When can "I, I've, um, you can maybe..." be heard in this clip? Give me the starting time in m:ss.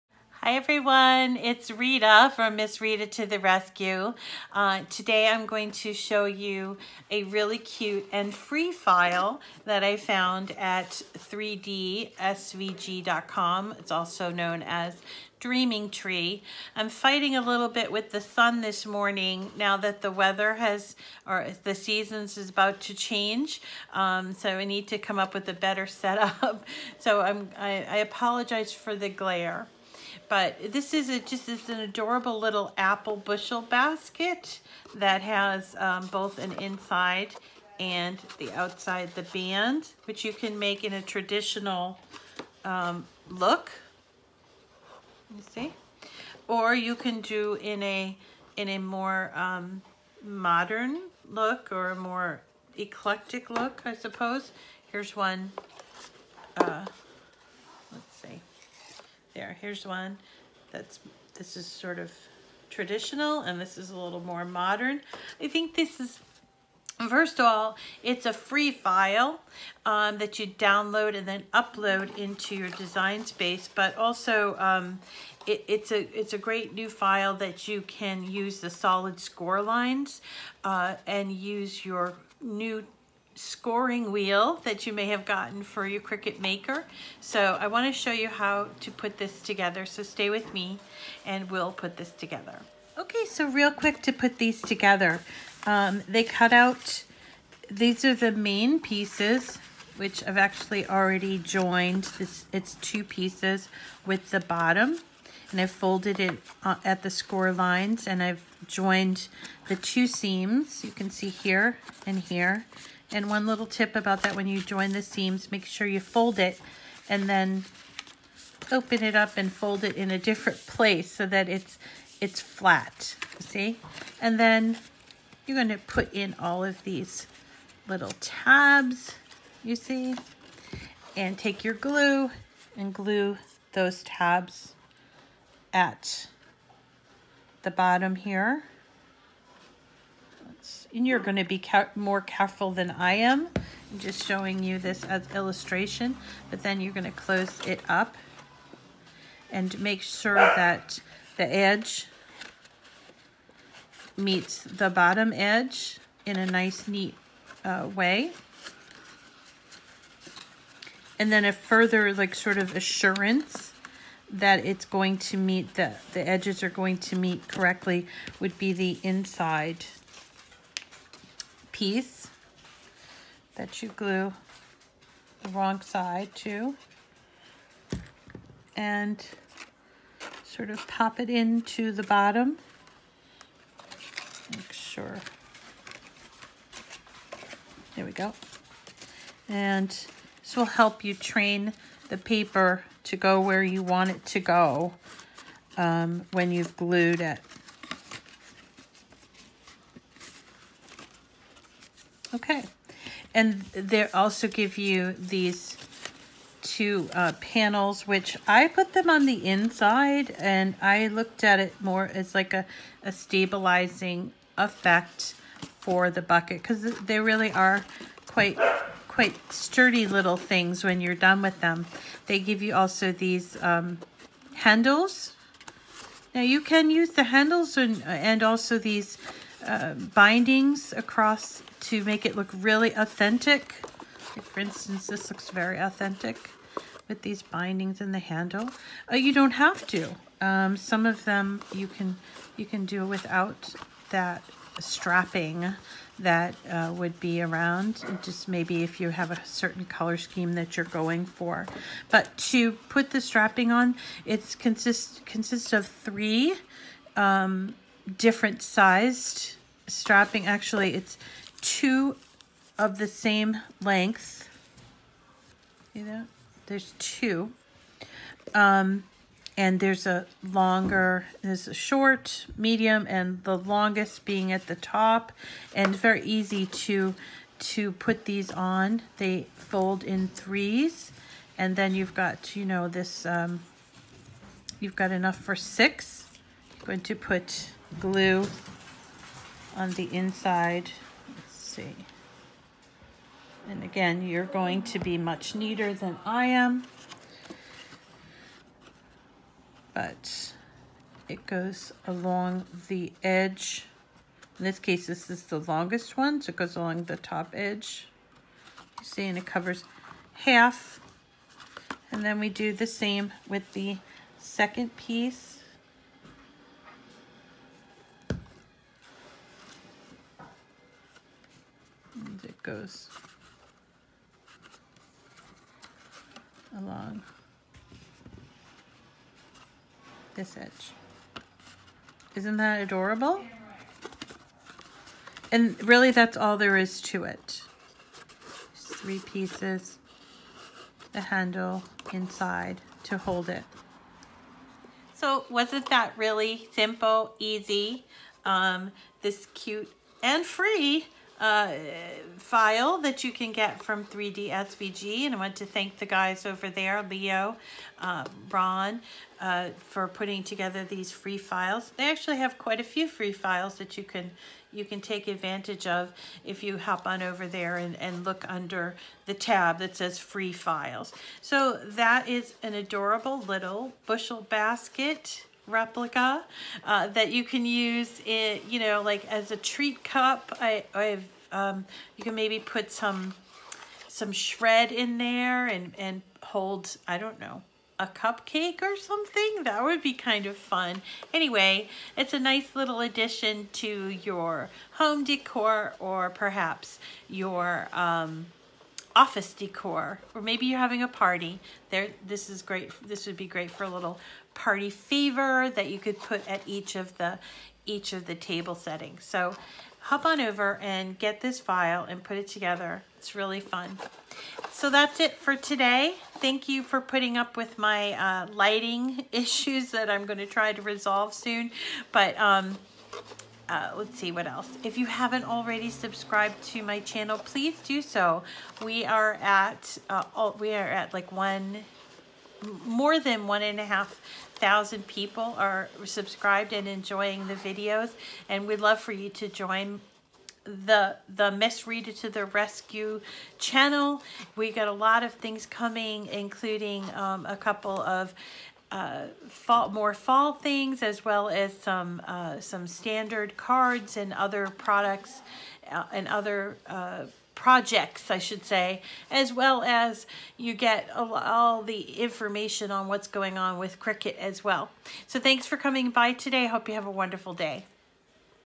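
6:20.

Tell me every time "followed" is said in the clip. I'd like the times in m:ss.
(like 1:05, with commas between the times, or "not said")
not said.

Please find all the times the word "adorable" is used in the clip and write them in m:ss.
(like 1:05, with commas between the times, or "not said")
0:31, 5:32, 6:12.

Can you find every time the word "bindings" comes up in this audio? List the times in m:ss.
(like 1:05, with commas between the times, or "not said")
3:49, 3:57.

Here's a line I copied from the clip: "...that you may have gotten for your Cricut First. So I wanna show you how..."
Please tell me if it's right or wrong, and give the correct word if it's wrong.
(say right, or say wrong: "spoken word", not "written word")
wrong: "Maker", not "First".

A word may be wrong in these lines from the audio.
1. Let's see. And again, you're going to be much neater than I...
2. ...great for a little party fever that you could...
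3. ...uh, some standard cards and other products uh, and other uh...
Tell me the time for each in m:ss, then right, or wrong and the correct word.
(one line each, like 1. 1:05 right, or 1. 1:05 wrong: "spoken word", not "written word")
1. 4:51 right
2. 6:43 right
3. 7:32 right.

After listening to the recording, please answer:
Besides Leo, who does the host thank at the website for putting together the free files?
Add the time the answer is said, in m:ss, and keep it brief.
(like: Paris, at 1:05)
Ron, at 5:58.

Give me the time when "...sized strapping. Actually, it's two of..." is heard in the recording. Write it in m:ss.
4:18.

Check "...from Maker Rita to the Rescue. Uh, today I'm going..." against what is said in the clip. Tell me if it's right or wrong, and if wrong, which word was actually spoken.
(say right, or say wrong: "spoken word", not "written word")
wrong: "Miss", not "Maker".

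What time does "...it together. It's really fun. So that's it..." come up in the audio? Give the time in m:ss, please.
6:52.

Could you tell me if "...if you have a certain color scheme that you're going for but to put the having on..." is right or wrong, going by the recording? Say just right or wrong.
wrong.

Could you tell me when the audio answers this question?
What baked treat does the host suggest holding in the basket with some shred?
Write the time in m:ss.
6:27.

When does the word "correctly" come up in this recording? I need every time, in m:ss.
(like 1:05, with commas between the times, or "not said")
2:47.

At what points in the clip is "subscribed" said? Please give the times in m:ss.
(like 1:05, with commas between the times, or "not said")
7:05, 7:16.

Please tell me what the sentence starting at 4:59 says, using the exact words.
But it goes along the edge.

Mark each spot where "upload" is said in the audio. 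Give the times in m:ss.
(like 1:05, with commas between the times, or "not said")
1:11.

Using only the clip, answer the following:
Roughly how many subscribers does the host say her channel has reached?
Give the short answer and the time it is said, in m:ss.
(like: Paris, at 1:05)
1,500, at 7:13.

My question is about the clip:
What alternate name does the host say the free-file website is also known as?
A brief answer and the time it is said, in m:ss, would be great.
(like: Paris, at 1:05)
Dreaming Tree, at 0:15.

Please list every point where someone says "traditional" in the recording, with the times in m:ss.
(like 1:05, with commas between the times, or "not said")
0:41, 1:02.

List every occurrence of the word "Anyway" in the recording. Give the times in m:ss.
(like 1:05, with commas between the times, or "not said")
6:31.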